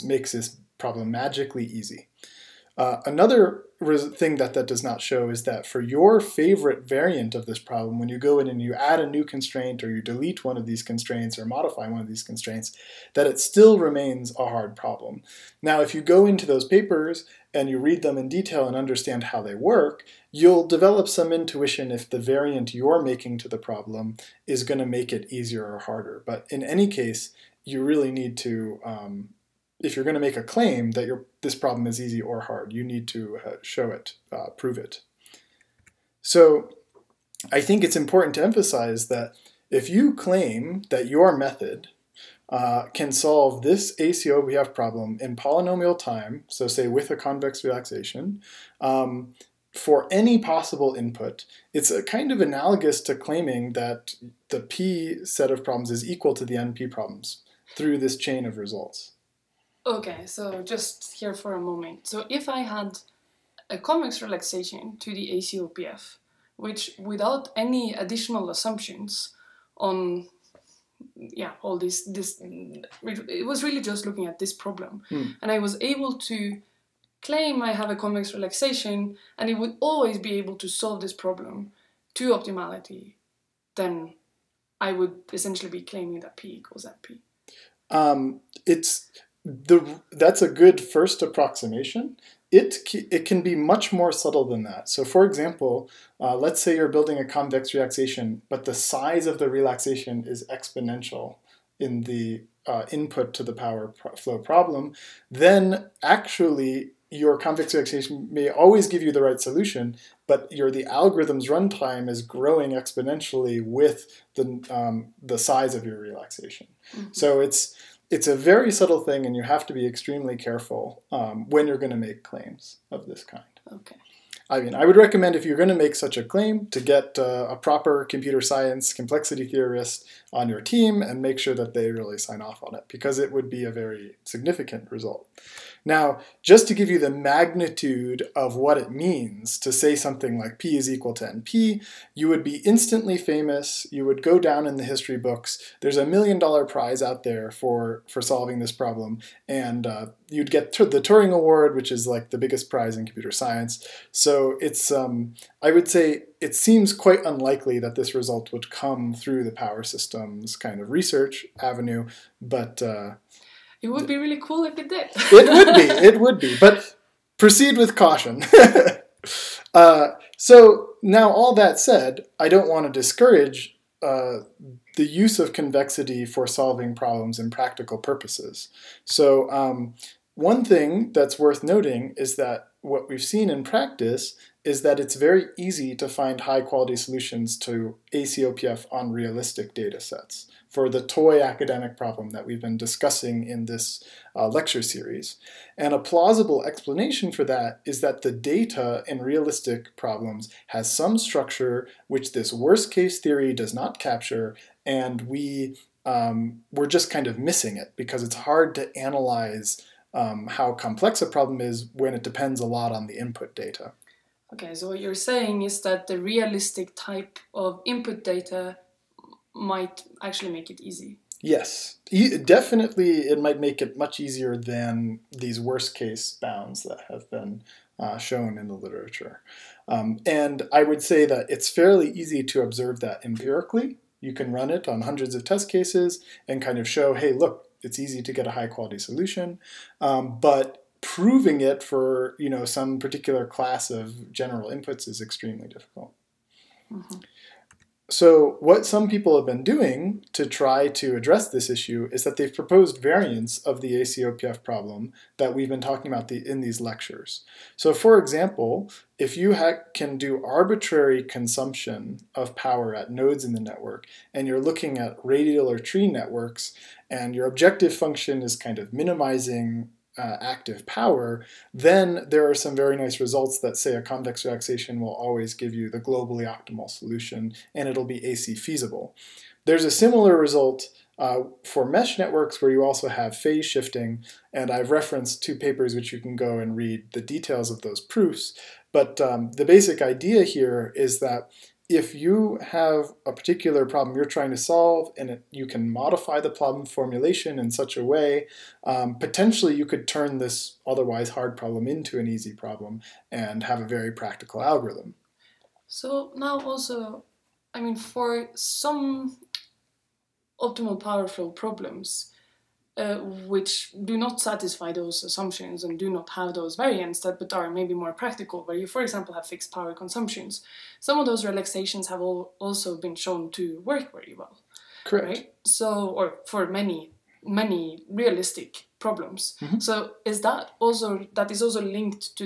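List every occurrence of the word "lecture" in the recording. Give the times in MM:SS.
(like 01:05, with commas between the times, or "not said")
03:14, 04:16.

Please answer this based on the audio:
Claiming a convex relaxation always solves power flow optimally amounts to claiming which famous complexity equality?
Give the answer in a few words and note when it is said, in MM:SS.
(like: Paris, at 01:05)
P equals NP, at 01:26.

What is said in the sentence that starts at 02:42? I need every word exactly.
Uh, it would be really cool if it did.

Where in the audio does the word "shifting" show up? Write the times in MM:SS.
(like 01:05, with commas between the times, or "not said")
04:43.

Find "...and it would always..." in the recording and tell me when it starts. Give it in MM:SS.
01:19.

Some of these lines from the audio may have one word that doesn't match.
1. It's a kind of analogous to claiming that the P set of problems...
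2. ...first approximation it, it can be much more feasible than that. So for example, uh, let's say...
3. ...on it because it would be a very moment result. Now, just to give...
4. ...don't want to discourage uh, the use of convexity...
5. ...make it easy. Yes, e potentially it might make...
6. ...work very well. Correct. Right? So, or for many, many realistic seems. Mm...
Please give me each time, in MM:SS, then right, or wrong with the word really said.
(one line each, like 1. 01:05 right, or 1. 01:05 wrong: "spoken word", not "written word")
1. 00:51 right
2. 01:30 wrong: "subtle", not "feasible"
3. 02:12 wrong: "significant", not "moment"
4. 02:52 right
5. 03:40 wrong: "definitely", not "potentially"
6. 05:23 wrong: "problems", not "seems".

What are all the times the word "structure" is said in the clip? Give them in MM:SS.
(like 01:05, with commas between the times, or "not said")
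03:21.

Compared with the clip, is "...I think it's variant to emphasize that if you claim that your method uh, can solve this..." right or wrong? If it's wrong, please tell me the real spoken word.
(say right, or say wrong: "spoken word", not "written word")
wrong: "important", not "variant".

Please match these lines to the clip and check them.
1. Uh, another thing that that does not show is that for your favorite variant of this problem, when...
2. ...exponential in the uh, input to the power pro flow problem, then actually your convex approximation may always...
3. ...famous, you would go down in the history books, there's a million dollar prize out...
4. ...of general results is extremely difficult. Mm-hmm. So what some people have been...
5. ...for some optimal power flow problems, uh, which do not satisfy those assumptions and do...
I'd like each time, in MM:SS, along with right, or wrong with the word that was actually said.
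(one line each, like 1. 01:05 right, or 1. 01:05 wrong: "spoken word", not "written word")
1. 00:02 right
2. 01:40 wrong: "relaxation", not "approximation"
3. 02:23 right
4. 04:03 wrong: "inputs", not "results"
5. 05:07 right.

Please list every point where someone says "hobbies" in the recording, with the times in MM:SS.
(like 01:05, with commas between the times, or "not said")
not said.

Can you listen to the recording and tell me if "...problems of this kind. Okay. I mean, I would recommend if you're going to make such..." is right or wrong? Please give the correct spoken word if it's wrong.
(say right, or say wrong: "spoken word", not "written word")
wrong: "claims", not "problems".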